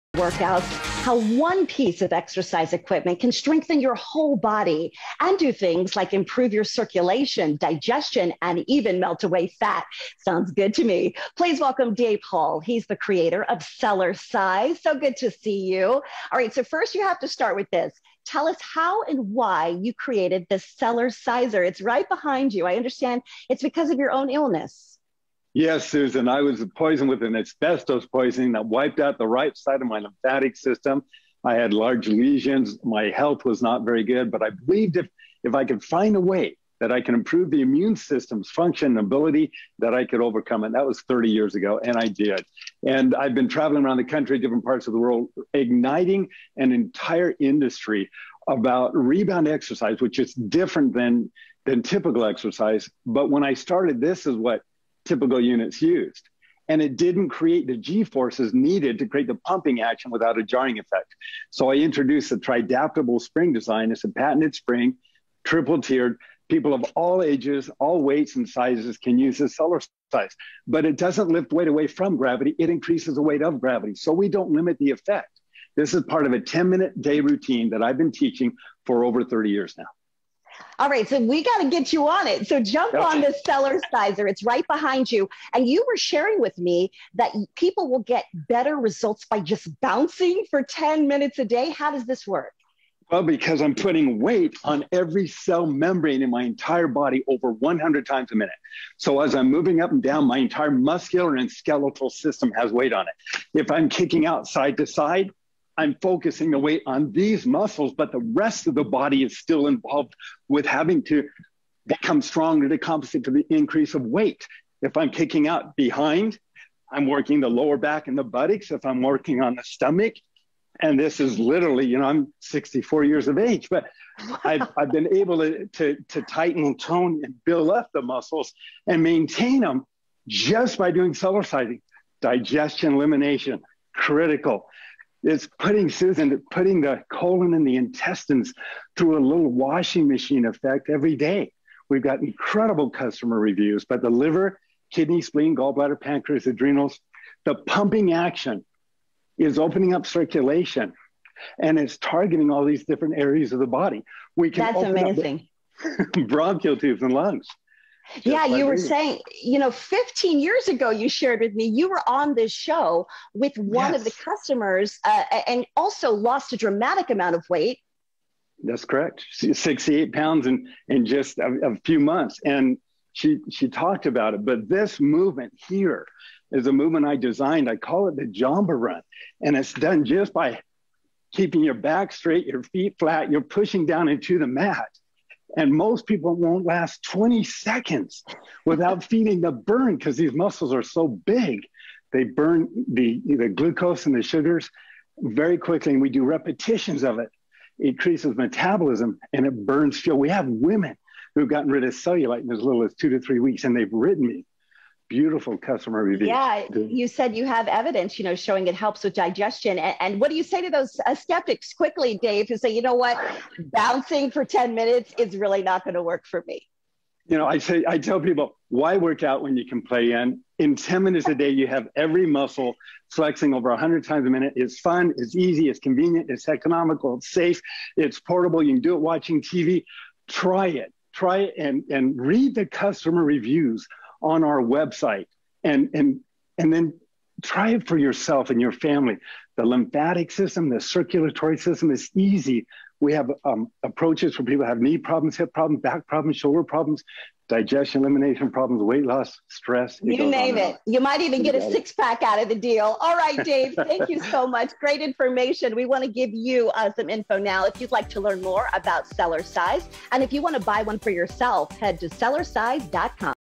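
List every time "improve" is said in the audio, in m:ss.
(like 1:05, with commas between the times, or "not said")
0:06, 0:37.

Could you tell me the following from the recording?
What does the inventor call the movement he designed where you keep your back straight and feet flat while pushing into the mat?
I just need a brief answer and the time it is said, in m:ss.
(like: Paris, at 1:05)
Jamba Run, at 2:58.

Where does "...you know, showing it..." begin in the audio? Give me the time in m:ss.
3:28.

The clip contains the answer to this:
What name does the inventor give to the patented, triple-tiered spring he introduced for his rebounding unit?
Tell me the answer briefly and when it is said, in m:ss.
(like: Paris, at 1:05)
tridaptable spring, at 1:02.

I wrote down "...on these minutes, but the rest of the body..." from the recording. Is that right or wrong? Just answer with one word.
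wrong.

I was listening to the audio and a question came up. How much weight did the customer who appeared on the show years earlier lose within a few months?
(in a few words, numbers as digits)
68 pounds.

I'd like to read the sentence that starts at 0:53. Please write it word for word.
But when I started, this is what typical units used.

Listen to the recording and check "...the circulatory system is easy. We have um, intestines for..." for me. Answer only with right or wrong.
wrong.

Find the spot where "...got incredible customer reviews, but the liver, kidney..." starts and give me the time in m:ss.
2:22.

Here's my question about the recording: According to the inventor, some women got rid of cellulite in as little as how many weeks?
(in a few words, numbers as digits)
2 to 3 weeks.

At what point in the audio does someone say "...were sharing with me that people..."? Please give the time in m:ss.
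1:25.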